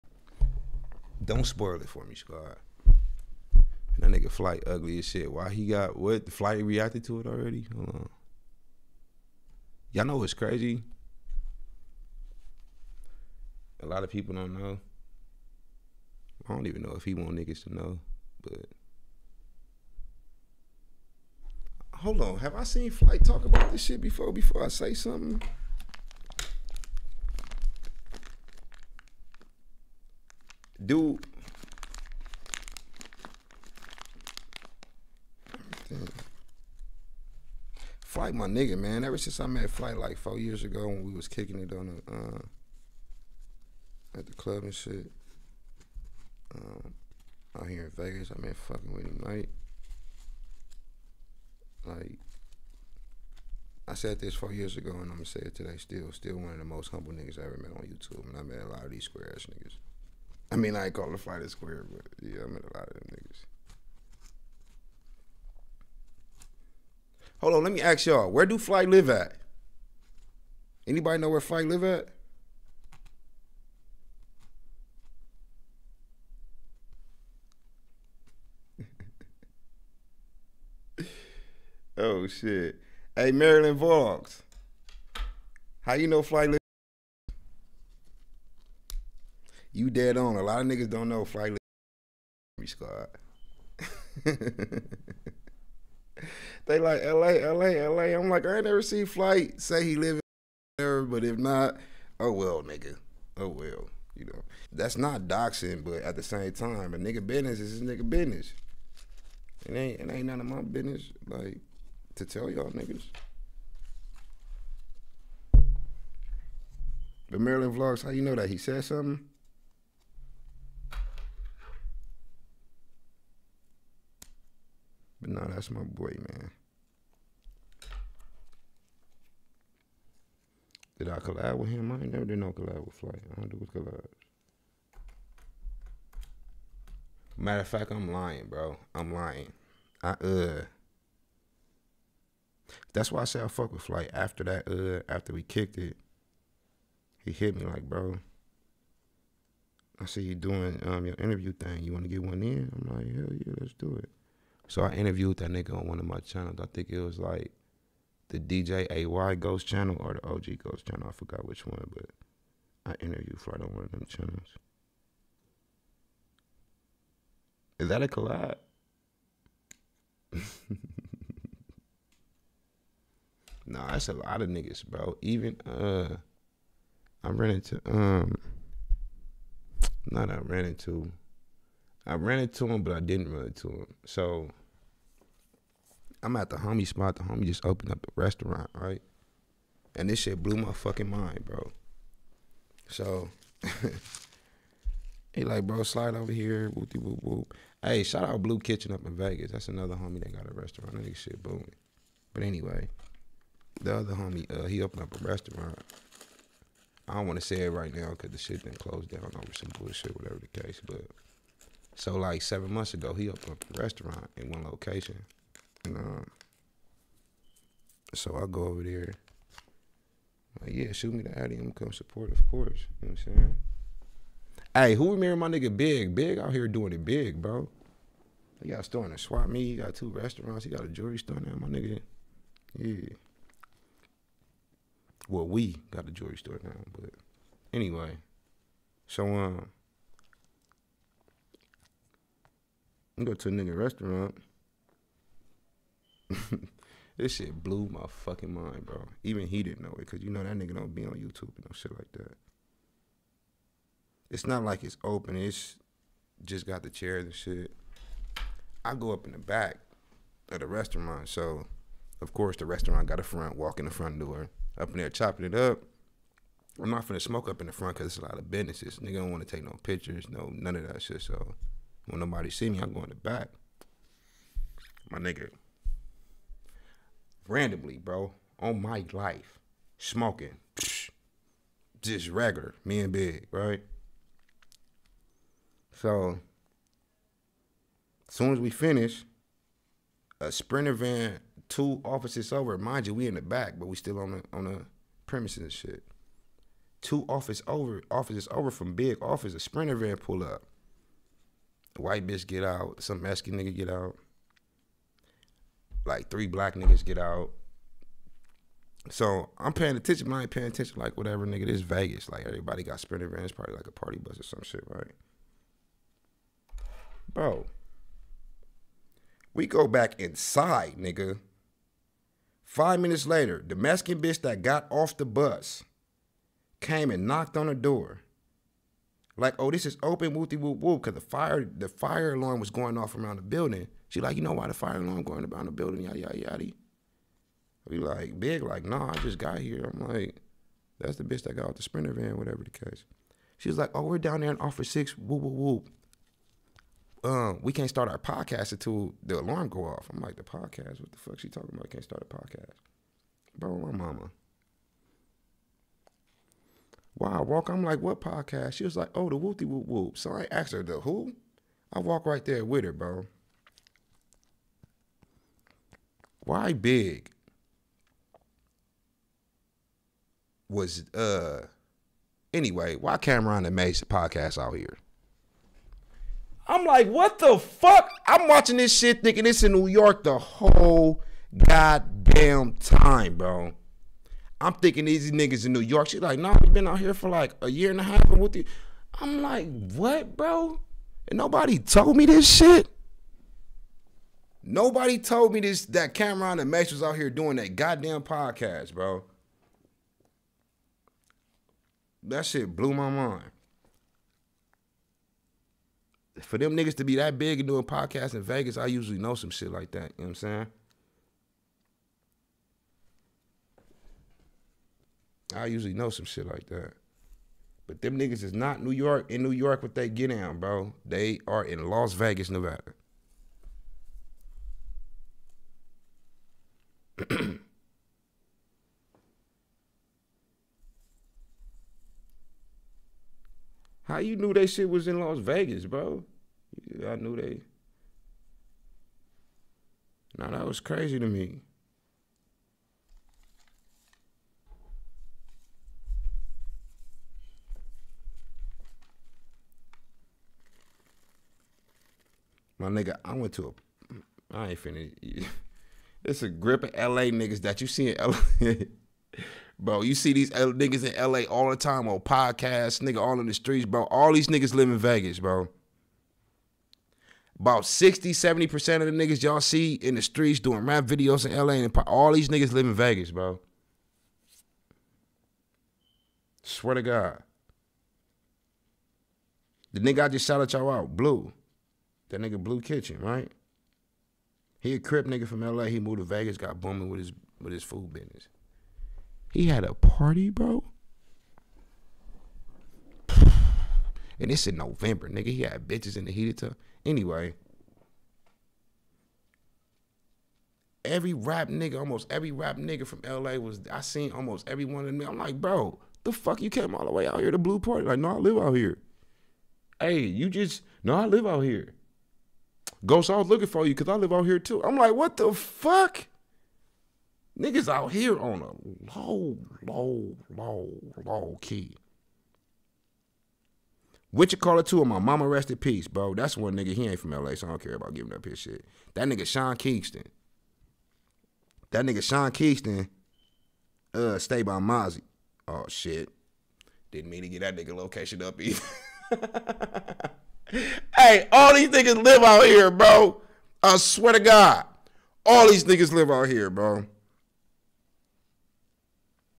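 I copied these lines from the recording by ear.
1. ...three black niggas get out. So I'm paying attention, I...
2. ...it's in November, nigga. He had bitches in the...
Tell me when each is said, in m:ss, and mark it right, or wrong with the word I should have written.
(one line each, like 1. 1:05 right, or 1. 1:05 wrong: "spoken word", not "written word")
1. 5:06 right
2. 8:14 right.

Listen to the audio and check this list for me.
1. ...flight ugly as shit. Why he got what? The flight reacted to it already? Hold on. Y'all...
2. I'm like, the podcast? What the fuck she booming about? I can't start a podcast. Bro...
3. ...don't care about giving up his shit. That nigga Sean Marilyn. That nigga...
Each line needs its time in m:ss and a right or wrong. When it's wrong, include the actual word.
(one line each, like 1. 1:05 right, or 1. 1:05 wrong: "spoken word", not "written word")
1. 0:04 right
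2. 5:50 wrong: "talking", not "booming"
3. 8:47 wrong: "Kingston", not "Marilyn".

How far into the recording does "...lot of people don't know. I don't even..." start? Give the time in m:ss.
0:13.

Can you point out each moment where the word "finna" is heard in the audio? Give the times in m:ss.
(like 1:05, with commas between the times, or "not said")
4:27, 7:34.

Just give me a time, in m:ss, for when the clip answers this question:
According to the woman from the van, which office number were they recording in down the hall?
5:44.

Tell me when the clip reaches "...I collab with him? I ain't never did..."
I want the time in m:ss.
2:11.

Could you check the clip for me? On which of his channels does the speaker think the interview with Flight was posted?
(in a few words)
DJ AY Ghost.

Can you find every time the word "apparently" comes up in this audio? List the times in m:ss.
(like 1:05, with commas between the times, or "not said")
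not said.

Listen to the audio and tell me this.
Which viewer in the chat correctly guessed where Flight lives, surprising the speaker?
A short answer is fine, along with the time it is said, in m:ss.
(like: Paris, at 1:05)
Marilyn Vlogs, at 1:23.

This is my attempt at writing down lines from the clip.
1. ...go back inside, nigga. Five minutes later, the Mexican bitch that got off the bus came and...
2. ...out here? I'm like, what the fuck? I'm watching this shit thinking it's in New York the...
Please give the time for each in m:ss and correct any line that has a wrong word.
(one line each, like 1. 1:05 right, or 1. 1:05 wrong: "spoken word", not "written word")
1. 5:19 right
2. 6:14 right.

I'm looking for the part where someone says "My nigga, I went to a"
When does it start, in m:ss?
7:32.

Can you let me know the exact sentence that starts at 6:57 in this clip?
But them niggas is not New York in New York what they get down, bro.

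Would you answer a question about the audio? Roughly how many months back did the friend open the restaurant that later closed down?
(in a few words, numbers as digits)
7.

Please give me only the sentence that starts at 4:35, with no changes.
My nigga, randomly, bro, on my life, smoking, just regular, me and Big, right?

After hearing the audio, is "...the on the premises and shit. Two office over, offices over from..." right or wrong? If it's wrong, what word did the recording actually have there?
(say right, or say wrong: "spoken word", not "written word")
right.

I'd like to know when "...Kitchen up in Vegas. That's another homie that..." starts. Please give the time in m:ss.
3:18.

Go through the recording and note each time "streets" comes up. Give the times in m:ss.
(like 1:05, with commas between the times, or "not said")
7:43, 7:50.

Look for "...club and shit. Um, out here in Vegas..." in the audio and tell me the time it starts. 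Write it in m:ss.
0:44.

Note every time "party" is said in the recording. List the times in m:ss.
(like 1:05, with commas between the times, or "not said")
5:13, 8:09, 8:27.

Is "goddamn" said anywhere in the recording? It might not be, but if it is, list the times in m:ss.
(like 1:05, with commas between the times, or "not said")
6:21, 6:37.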